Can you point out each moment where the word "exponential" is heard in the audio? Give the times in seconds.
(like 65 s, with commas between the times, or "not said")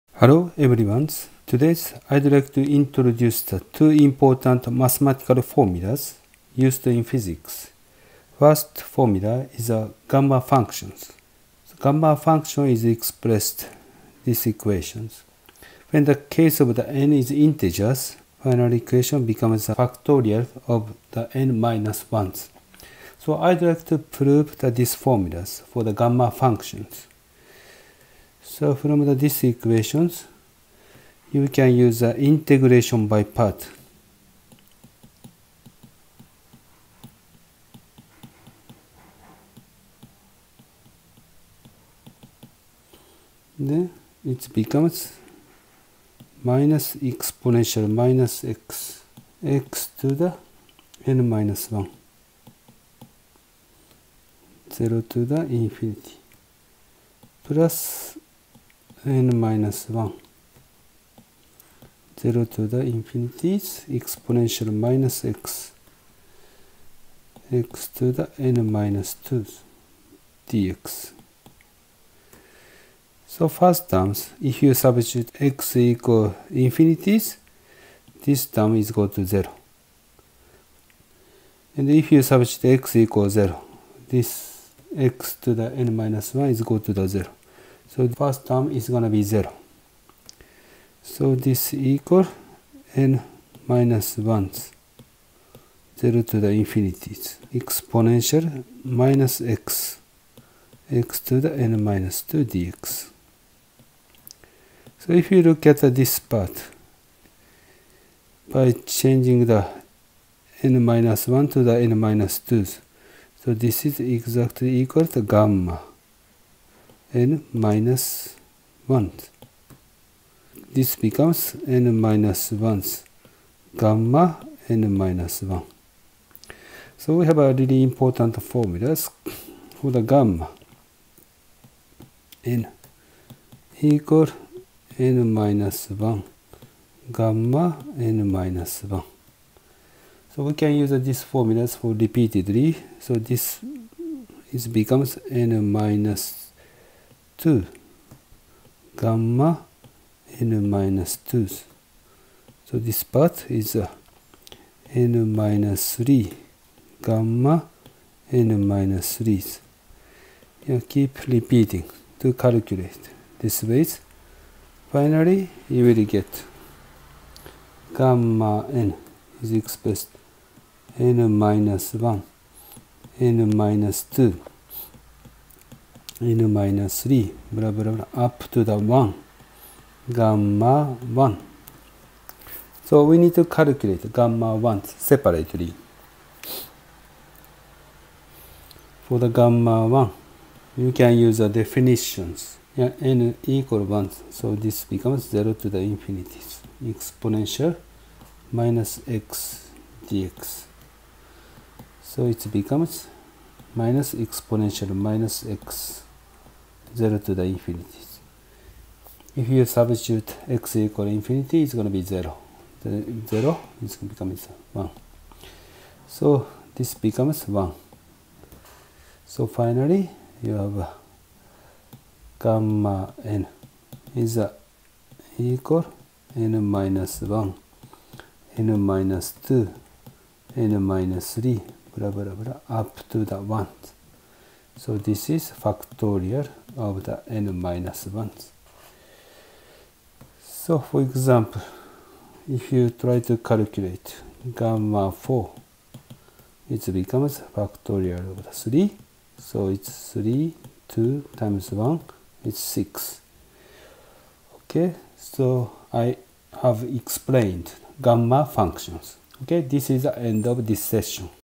46 s, 63 s, 97 s, 196 s, 204 s.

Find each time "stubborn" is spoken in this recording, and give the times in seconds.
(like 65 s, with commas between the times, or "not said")
not said.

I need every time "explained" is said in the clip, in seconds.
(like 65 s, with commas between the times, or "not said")
256 s.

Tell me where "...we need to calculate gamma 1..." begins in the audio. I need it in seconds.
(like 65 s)
183 s.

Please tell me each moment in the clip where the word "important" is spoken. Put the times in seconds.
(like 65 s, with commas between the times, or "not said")
3 s, 127 s.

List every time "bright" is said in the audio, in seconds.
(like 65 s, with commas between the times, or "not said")
not said.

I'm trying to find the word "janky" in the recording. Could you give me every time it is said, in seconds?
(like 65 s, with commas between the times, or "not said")
not said.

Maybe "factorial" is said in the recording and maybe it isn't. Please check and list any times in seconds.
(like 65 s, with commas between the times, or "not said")
19 s, 235 s, 247 s.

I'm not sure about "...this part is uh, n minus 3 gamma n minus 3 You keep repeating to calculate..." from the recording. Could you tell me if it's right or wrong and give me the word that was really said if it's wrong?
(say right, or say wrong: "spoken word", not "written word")
right.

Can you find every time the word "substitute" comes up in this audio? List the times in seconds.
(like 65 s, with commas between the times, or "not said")
74 s, 82 s, 209 s.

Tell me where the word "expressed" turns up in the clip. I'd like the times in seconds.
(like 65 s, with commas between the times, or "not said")
12 s, 169 s.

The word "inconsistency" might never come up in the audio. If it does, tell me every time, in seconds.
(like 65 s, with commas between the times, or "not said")
not said.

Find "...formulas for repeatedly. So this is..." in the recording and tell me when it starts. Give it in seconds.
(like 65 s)
141 s.